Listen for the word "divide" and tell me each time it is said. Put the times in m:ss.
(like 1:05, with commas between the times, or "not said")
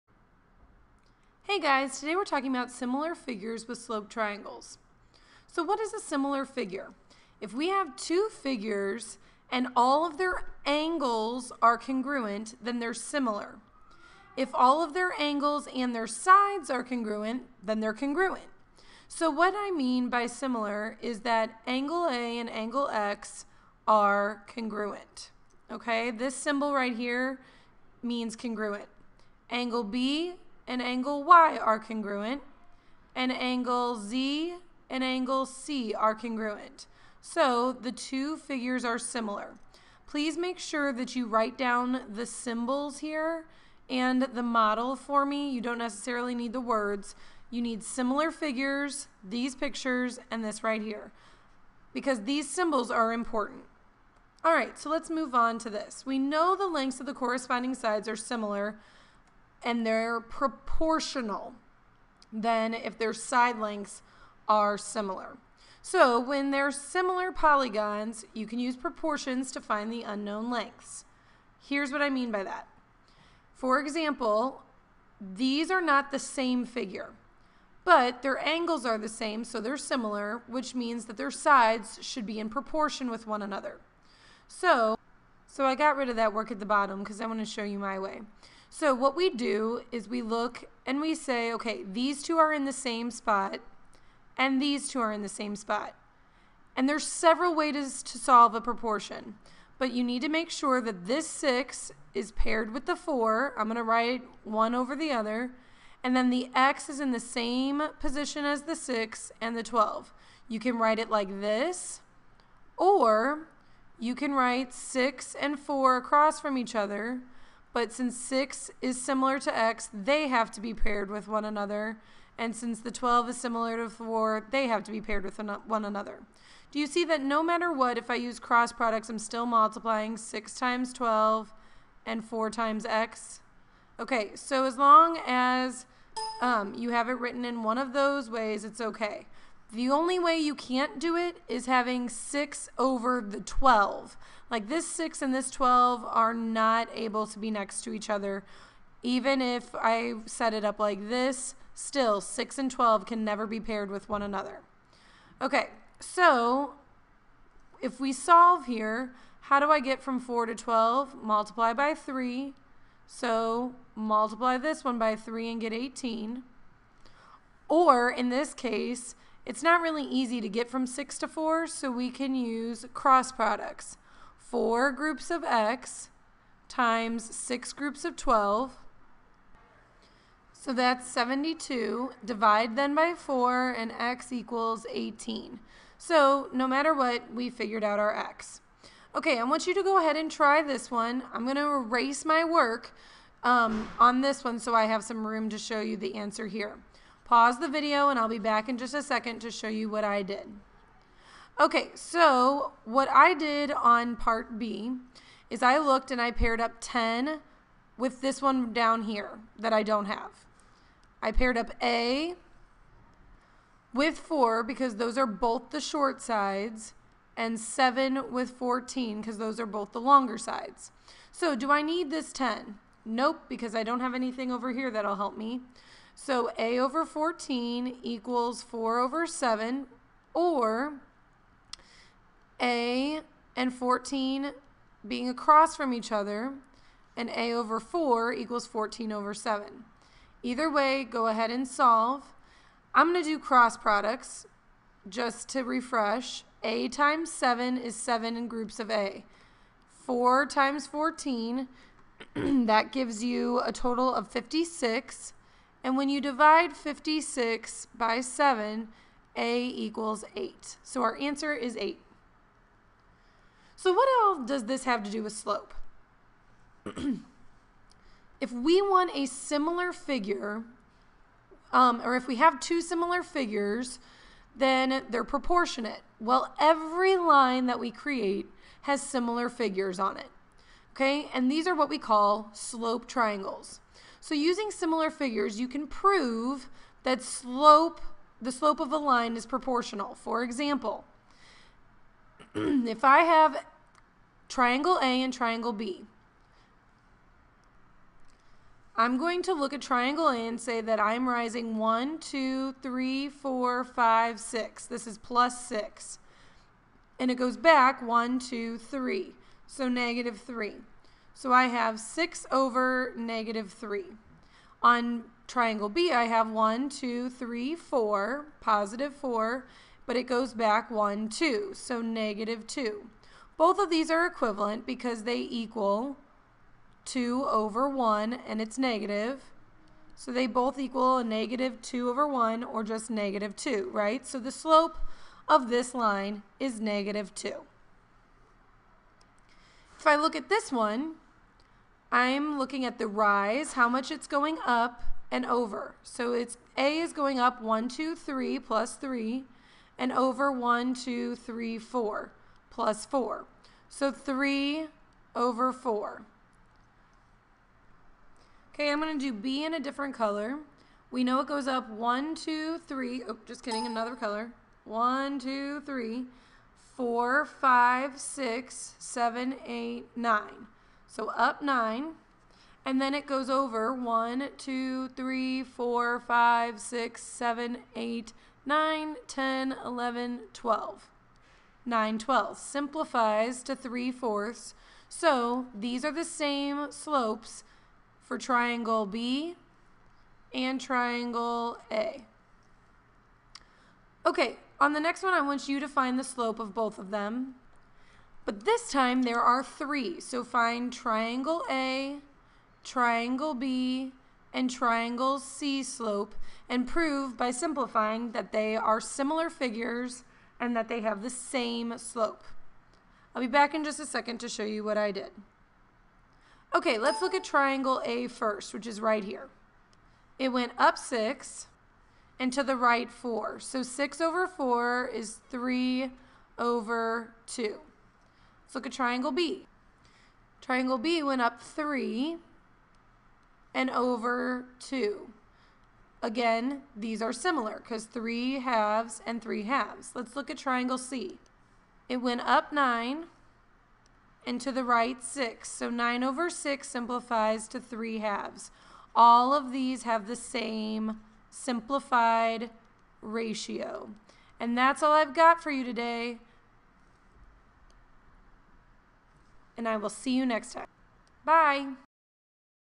3:02, 4:16.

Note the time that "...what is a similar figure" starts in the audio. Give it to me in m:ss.
0:05.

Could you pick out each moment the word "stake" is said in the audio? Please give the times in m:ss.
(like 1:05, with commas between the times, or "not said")
not said.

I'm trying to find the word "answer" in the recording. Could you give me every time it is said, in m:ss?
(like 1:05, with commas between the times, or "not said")
3:16, 4:21.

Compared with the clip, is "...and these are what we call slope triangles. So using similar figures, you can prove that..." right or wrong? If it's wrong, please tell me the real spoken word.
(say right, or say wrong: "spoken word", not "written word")
right.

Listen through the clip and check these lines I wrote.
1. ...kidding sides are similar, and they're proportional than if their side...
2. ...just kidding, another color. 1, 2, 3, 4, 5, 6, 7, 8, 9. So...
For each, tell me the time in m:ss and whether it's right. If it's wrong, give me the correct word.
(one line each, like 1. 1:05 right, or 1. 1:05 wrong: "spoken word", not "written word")
1. 0:57 wrong: "corresponding", not "kidding"
2. 6:03 right.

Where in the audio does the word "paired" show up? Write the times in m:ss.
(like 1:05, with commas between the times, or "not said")
1:42, 2:00, 2:05, 2:33, 3:26, 3:31.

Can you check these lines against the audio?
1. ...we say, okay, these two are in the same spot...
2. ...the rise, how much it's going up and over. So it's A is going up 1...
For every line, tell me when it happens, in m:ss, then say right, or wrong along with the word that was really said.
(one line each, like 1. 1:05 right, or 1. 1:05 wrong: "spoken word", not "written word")
1. 1:31 right
2. 5:42 right.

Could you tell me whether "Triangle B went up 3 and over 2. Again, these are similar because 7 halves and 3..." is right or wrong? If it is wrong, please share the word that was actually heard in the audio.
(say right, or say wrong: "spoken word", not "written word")
wrong: "3", not "7".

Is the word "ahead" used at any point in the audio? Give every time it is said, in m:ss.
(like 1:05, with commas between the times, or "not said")
3:09, 4:01.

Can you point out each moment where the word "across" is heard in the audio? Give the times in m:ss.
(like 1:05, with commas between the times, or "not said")
1:55, 3:55.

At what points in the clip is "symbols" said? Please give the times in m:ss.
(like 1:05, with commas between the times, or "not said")
0:26, 0:42, 0:52.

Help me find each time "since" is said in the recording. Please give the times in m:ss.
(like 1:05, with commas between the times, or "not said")
1:57, 2:02.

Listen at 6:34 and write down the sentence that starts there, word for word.
Okay, on the next one I want you to find the slope of both of them.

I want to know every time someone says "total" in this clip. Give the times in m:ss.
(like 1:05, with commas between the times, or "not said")
4:13.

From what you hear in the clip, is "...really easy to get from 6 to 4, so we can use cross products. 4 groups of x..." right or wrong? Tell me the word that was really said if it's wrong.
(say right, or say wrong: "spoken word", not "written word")
right.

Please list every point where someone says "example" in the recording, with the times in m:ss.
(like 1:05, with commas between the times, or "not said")
1:13, 4:50.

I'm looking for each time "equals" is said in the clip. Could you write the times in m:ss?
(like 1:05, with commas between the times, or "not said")
3:04, 3:48, 3:58, 4:19, 5:25, 5:30.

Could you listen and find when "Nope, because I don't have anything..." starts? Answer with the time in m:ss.
3:43.